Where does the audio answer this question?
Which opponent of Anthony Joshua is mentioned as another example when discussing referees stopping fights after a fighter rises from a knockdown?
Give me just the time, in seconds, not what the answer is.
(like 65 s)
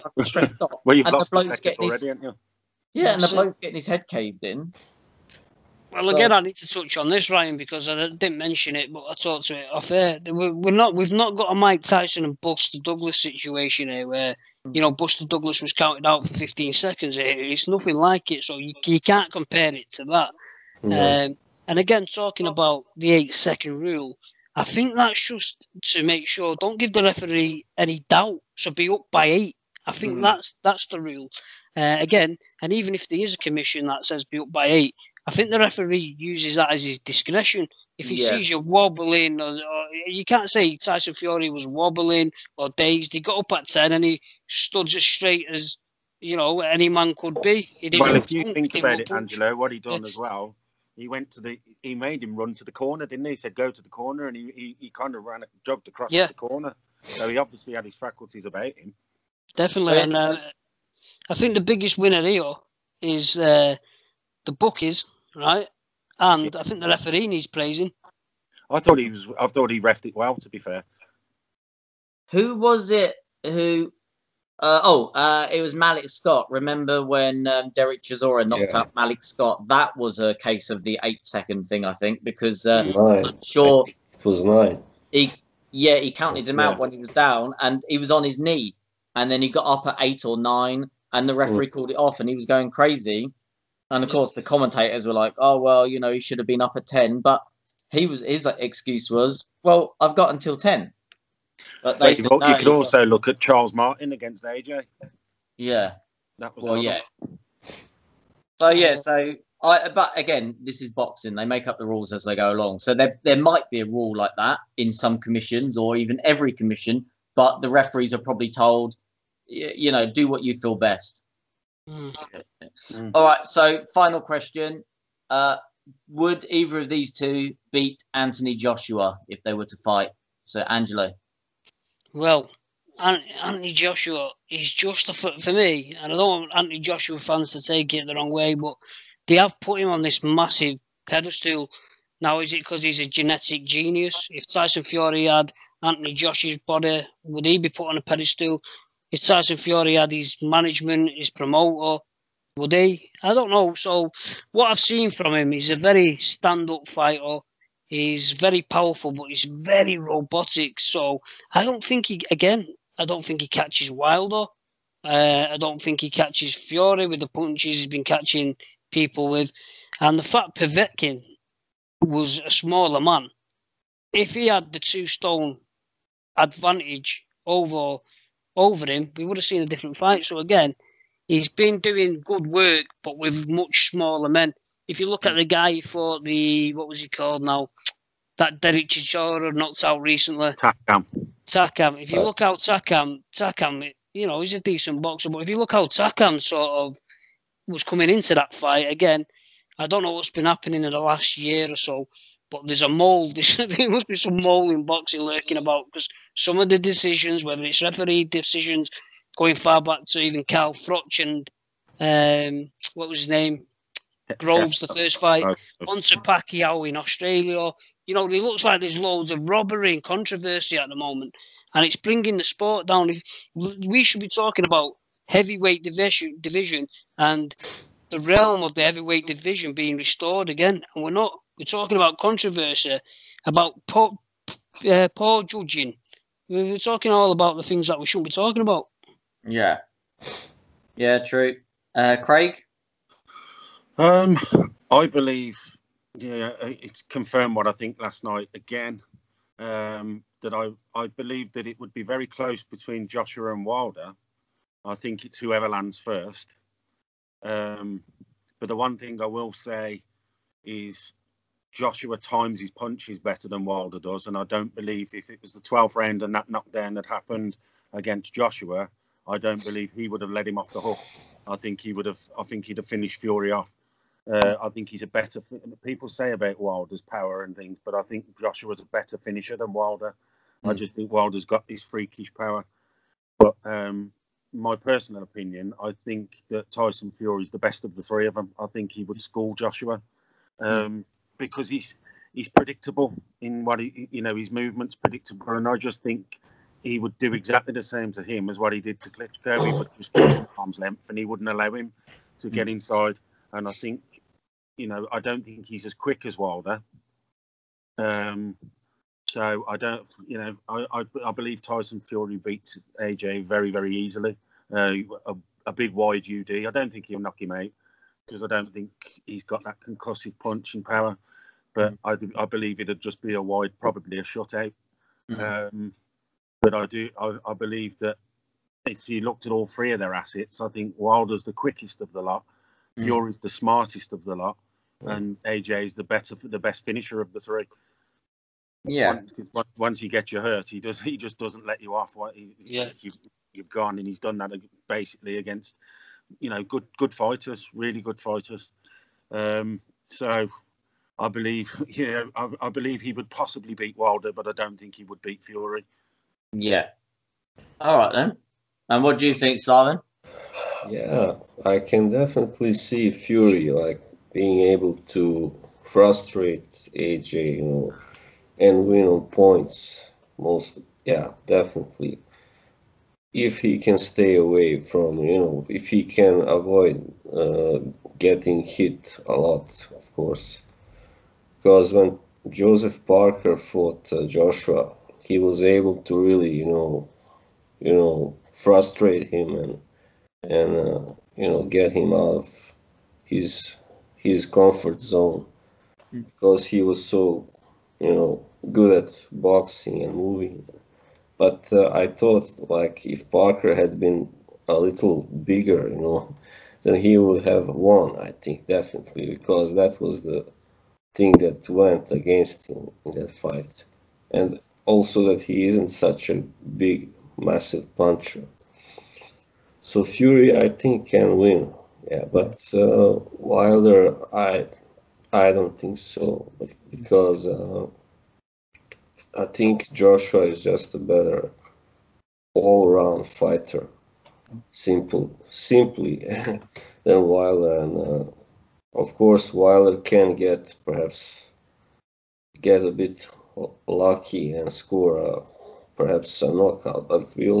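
103 s.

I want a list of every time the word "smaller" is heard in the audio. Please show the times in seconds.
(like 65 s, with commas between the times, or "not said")
172 s, 183 s.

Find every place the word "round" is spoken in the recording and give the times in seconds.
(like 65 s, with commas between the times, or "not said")
265 s, 432 s.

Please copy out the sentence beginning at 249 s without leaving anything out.
Um, that I, I believe that it would be very close between Joshua and Wilder.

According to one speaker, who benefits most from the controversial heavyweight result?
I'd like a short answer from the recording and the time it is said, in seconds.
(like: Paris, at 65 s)
The bookies, at 64 s.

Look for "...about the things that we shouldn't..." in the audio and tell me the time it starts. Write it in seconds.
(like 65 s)
237 s.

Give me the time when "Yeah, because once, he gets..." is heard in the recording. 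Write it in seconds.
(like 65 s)
338 s.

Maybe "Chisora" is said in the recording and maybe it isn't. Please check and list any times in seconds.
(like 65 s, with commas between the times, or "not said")
78 s, 188 s.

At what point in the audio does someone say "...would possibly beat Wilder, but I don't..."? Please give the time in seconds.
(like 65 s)
353 s.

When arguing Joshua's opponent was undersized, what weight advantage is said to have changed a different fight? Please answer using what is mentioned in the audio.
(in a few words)
2 stone.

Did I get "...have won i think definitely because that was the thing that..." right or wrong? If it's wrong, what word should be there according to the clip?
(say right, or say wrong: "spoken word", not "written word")
right.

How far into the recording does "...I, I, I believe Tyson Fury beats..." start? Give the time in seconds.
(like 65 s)
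310 s.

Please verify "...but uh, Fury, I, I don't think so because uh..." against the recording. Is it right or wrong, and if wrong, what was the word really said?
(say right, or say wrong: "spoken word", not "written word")
wrong: "Wilder", not "Fury".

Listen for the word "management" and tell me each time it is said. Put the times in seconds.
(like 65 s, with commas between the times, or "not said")
150 s.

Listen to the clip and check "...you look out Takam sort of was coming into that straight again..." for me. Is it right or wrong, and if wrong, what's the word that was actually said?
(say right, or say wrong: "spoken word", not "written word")
wrong: "fight", not "straight".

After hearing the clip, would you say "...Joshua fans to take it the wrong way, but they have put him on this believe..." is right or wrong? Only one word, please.
wrong.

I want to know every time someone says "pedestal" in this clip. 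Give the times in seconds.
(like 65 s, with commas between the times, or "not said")
141 s, 148 s.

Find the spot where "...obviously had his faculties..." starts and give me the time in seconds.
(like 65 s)
57 s.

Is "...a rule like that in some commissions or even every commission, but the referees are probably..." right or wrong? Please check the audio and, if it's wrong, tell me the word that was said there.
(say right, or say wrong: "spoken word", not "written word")
right.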